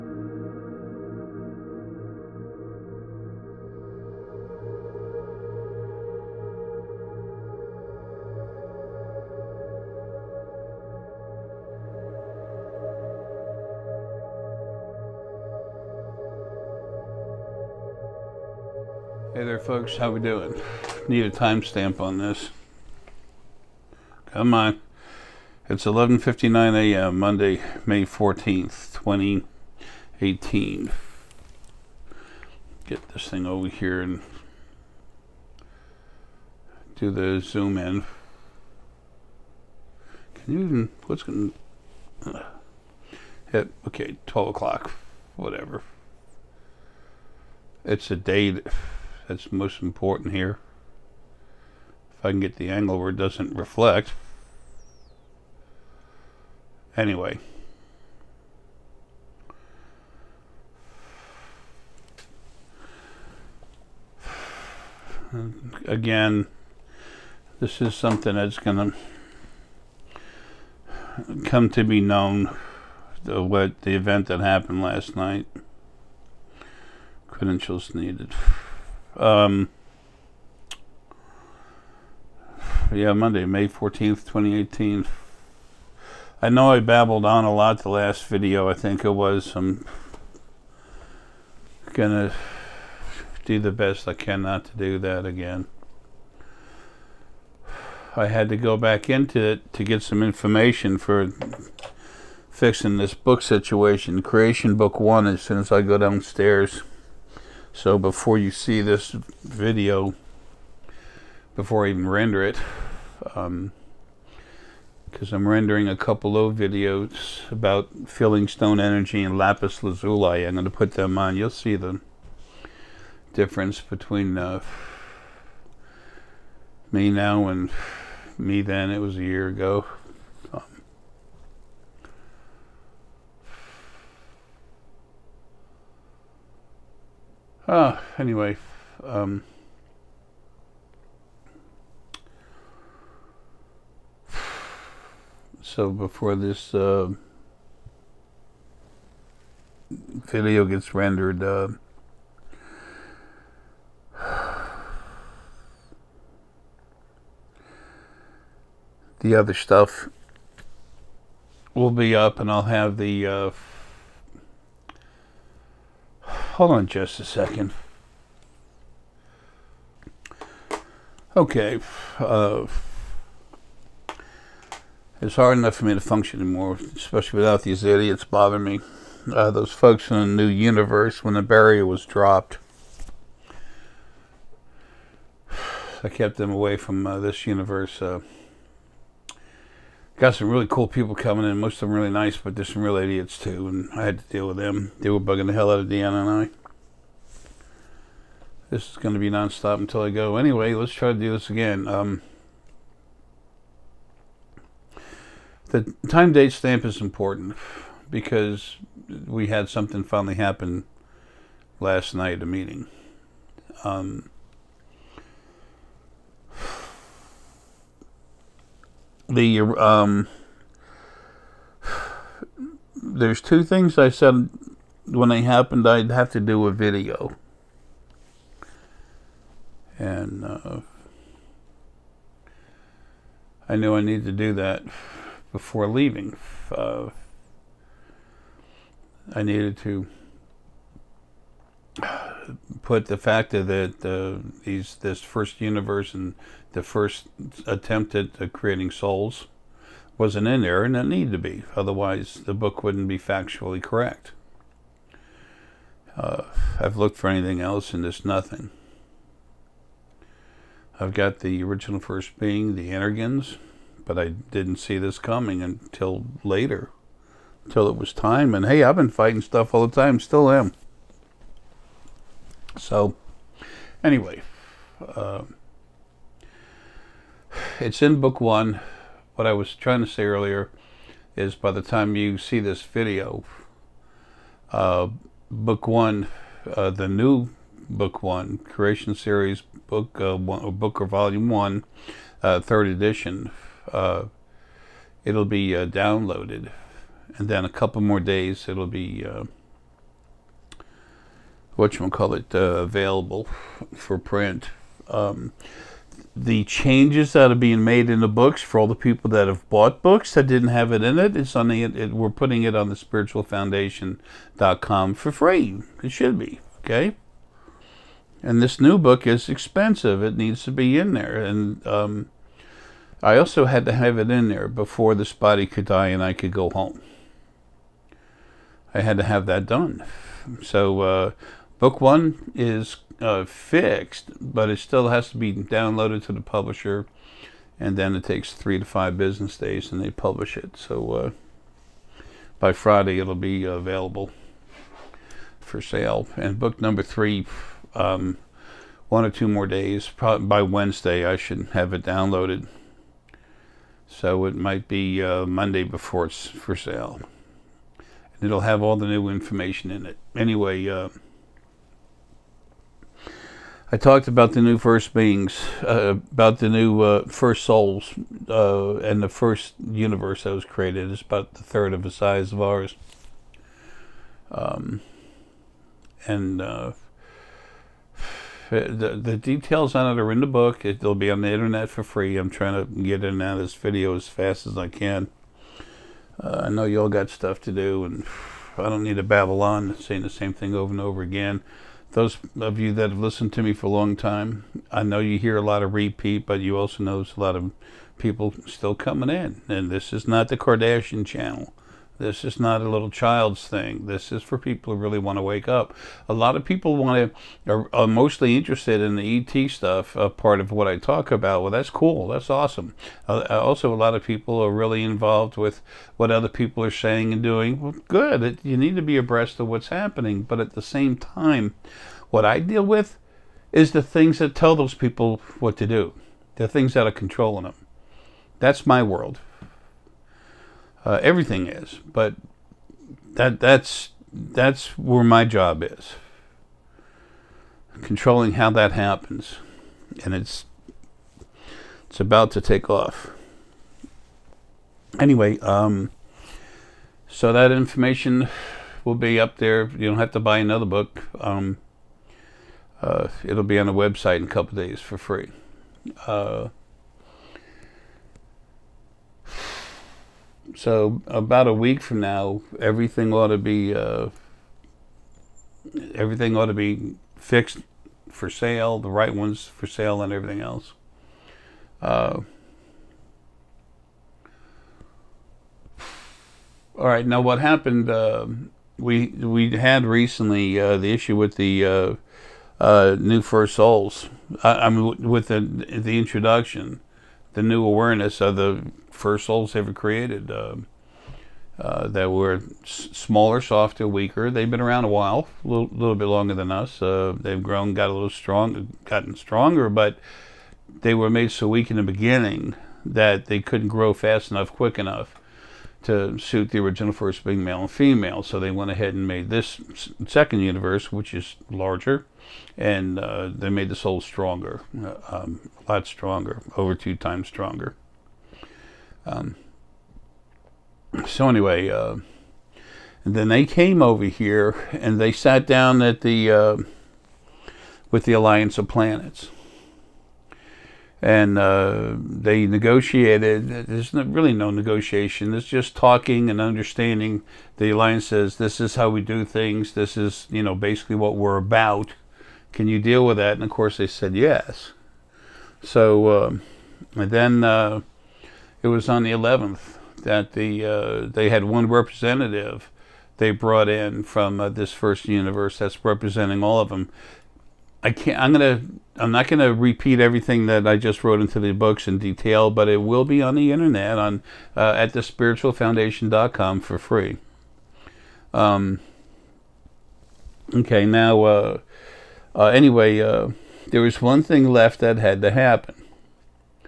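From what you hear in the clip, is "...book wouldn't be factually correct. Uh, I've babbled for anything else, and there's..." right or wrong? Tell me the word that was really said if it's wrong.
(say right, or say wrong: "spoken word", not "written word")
wrong: "looked", not "babbled".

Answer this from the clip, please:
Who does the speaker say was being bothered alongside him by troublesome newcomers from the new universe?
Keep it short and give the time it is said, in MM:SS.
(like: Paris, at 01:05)
Diana, at 03:15.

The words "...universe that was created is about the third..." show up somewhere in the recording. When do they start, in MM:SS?
06:09.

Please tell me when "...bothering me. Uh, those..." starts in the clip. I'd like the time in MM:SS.
02:58.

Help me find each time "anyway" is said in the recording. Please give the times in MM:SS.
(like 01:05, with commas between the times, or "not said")
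00:56, 02:18, 03:20, 04:34, 06:00, 07:25, 08:41, 09:32.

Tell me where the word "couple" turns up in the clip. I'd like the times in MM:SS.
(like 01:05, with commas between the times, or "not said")
01:55, 04:57, 07:34.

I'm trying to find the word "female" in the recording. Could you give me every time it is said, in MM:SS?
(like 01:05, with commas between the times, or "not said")
08:27.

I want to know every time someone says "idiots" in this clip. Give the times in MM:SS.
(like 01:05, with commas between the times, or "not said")
02:57, 03:12.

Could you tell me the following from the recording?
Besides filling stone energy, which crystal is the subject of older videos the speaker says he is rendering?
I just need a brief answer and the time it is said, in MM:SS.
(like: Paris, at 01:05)
lapis lazuli, at 01:59.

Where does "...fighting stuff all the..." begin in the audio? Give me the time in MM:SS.
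04:29.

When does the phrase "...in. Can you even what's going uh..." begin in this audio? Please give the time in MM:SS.
00:37.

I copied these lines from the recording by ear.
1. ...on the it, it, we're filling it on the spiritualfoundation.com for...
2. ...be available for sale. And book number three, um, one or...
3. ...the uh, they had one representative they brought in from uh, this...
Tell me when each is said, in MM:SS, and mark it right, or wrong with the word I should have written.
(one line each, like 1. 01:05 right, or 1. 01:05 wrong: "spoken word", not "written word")
1. 05:11 wrong: "putting", not "filling"
2. 05:43 right
3. 09:10 right.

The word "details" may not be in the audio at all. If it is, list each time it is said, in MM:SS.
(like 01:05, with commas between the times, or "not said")
06:19, 09:22.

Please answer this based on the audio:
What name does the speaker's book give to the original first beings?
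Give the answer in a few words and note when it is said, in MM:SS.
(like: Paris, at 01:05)
the Energans, at 04:22.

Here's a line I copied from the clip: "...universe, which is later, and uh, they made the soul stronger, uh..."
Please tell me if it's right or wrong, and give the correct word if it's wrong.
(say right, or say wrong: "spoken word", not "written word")
wrong: "larger", not "later".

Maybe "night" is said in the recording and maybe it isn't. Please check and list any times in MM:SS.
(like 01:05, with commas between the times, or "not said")
01:15, 03:32.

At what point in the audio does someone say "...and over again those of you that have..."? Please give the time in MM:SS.
06:30.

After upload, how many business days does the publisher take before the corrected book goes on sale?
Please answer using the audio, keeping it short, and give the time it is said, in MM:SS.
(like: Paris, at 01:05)
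3 to 5, at 05:38.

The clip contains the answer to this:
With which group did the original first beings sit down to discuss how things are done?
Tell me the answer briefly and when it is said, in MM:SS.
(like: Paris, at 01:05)
Alliance of Planets, at 08:48.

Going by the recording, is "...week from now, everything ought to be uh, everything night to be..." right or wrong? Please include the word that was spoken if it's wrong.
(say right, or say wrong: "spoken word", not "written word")
wrong: "ought", not "night".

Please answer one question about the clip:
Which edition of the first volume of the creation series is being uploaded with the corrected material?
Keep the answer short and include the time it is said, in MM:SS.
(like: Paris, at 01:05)
third edition, at 04:52.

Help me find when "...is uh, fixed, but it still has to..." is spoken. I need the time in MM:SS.
05:32.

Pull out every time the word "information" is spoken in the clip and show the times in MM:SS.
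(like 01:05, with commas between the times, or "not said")
01:40, 05:59, 07:27.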